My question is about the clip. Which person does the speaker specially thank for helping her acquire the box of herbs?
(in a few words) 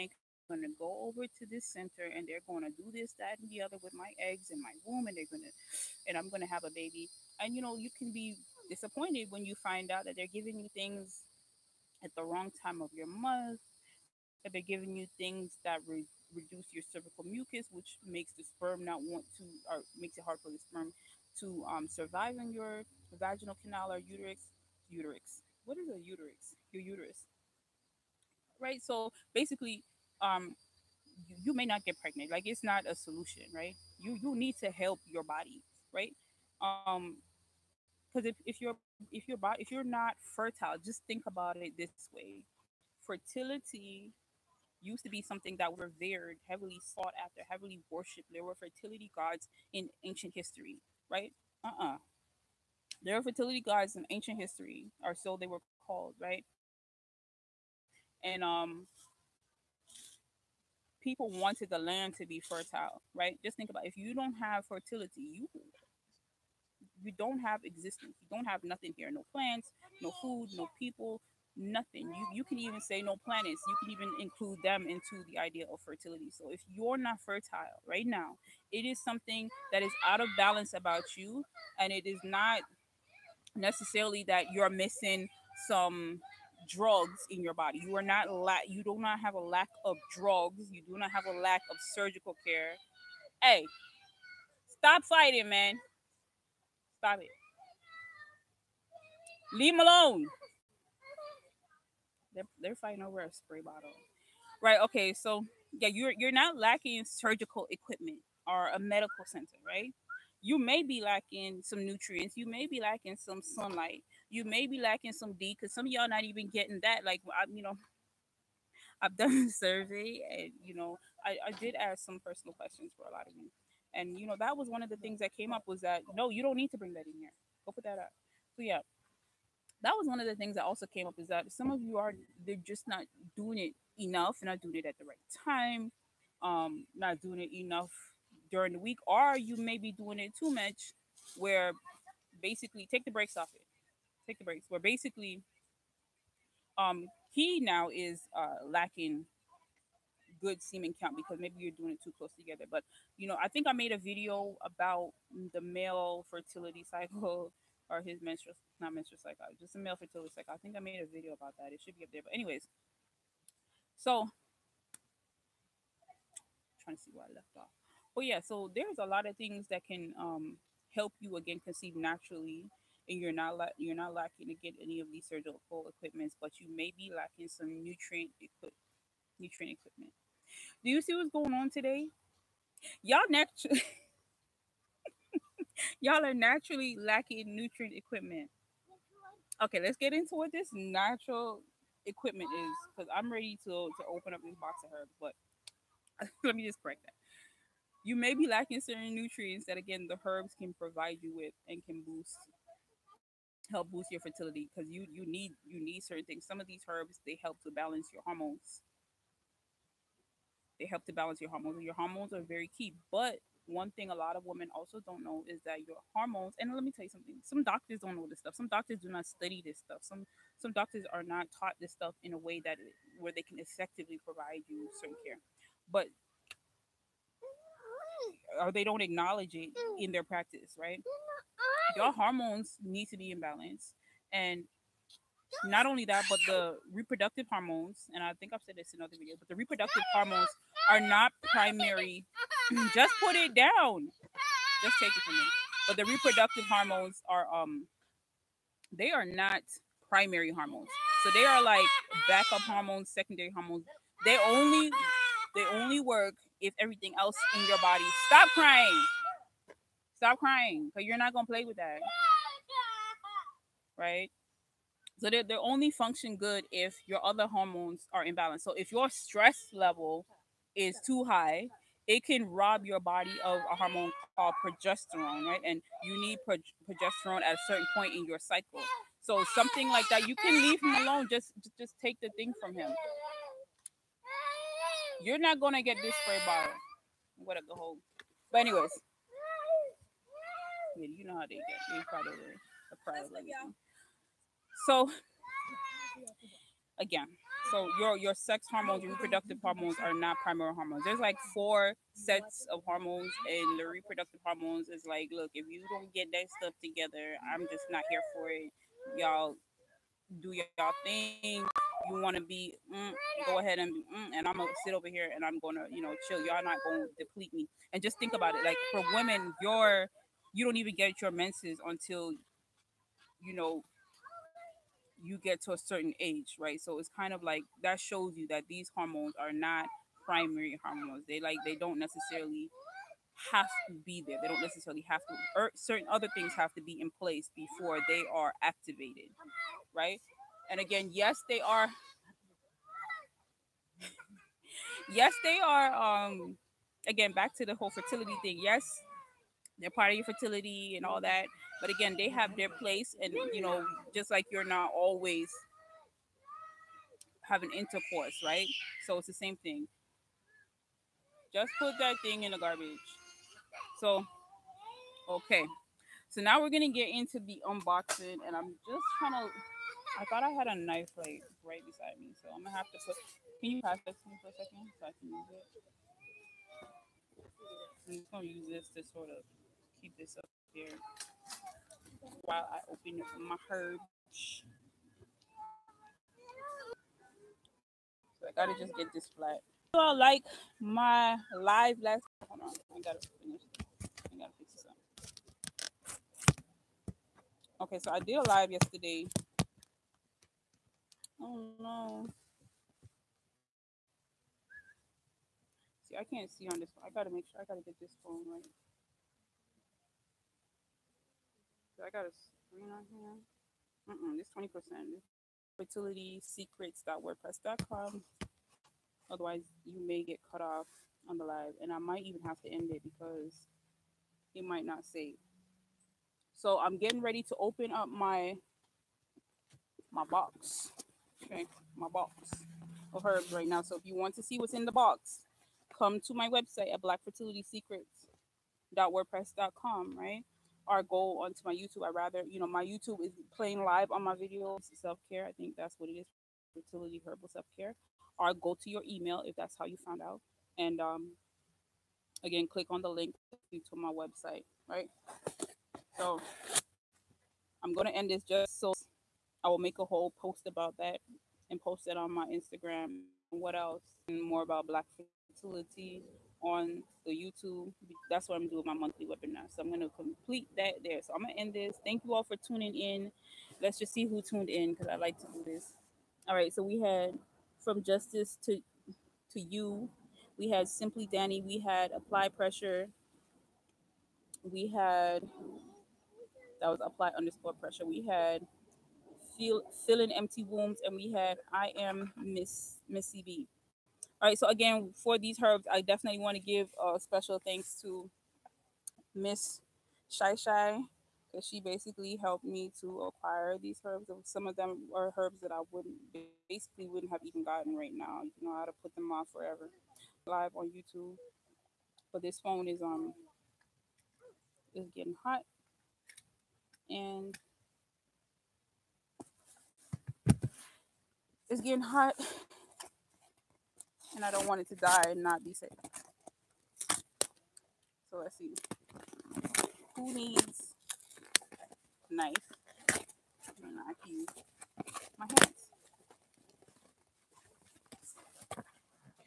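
Miss Shai Shai.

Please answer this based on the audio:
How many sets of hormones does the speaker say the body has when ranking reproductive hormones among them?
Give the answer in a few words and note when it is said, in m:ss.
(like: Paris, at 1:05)
4, at 5:01.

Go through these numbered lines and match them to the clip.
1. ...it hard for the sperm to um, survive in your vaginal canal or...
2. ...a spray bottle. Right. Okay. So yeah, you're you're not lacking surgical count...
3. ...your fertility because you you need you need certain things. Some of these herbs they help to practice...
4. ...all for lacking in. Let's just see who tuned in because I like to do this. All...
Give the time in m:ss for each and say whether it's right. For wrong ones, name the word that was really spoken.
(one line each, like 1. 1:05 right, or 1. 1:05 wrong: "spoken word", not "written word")
1. 0:20 right
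2. 1:43 wrong: "equipment", not "count"
3. 3:24 wrong: "balance", not "practice"
4. 7:52 wrong: "tuning", not "lacking".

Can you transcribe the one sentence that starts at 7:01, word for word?
And I might even have to end it because it might not save.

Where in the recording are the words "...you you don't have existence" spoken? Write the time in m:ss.
1:05.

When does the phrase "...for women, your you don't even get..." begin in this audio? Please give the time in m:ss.
5:18.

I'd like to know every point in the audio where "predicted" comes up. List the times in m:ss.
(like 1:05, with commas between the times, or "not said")
not said.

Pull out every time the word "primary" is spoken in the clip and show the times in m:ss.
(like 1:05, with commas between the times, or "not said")
4:01, 4:10, 5:00, 5:30.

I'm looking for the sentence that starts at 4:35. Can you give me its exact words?
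And you need pro- progesterone at a certain point in your cycle.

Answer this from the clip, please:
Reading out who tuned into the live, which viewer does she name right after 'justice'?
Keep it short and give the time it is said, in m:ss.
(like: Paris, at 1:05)
Simply Danny, at 8:00.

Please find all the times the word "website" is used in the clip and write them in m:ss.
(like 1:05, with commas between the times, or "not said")
7:16, 7:34.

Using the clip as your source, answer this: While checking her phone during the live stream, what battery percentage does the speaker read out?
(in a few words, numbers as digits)
20%.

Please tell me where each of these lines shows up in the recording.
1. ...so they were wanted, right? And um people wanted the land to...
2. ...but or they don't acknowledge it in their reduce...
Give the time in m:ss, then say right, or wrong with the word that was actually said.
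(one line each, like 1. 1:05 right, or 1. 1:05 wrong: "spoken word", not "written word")
1. 0:55 wrong: "called", not "wanted"
2. 3:45 wrong: "practice", not "reduce".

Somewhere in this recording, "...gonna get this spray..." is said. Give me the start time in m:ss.
4:45.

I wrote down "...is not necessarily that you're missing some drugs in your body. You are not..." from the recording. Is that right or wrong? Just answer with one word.
right.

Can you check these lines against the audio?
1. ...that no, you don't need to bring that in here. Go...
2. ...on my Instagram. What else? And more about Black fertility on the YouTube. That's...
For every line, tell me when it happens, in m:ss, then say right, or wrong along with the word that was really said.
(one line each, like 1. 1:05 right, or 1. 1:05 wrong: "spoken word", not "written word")
1. 2:05 right
2. 7:42 right.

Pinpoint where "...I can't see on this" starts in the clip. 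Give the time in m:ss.
6:46.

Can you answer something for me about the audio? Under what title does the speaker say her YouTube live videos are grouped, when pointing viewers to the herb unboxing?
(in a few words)
Fertility herbal self care.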